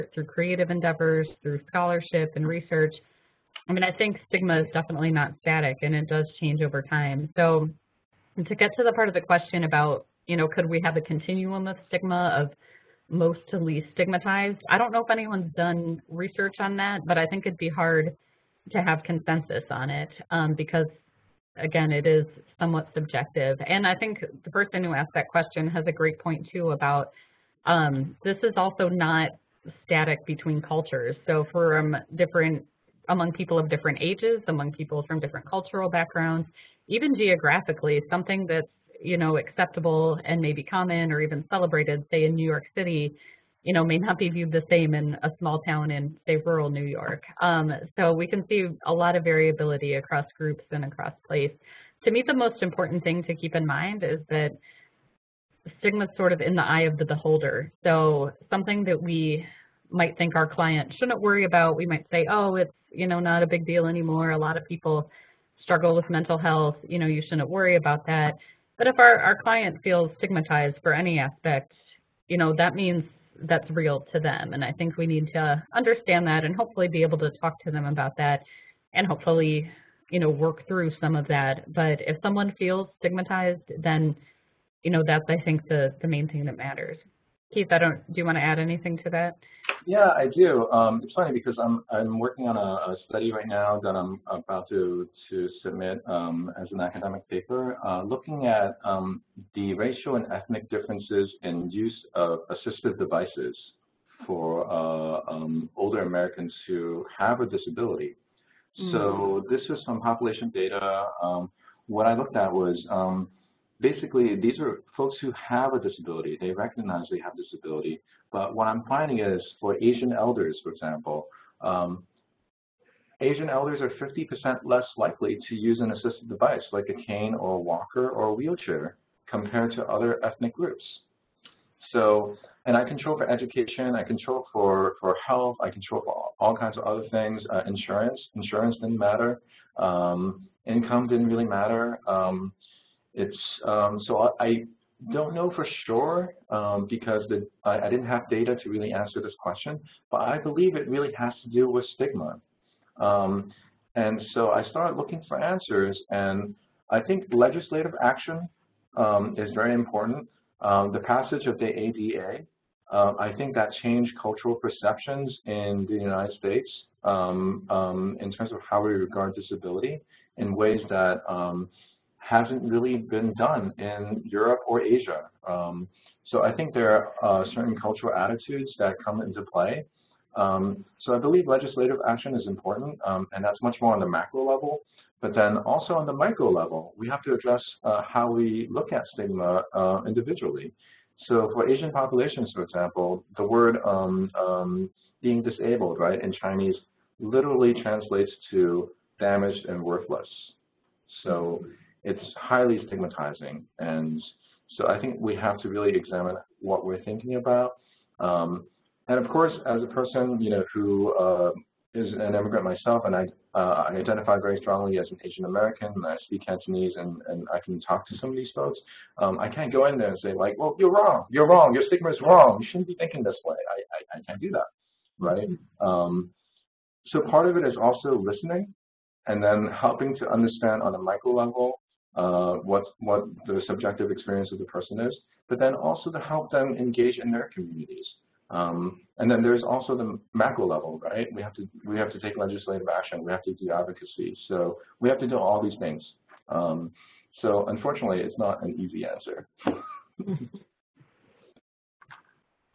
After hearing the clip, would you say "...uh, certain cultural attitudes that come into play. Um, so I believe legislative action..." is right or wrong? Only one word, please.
right.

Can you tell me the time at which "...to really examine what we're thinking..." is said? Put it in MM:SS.
03:25.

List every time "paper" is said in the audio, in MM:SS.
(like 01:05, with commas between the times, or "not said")
01:37.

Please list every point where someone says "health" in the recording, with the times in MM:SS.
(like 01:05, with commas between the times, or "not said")
01:06, 02:15.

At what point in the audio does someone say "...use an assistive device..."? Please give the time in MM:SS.
02:05.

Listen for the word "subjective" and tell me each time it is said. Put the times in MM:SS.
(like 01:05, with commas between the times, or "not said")
00:22, 03:53.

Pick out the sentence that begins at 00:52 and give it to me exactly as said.
To me, the most important thing to keep in mind is that stigma is sort of in the eye of the beholder.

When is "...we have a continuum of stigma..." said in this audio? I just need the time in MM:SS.
00:10.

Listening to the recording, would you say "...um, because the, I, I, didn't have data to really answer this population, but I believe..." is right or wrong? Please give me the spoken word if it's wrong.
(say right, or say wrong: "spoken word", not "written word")
wrong: "question", not "population".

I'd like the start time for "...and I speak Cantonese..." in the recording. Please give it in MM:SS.
03:35.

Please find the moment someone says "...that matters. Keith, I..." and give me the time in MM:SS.
01:26.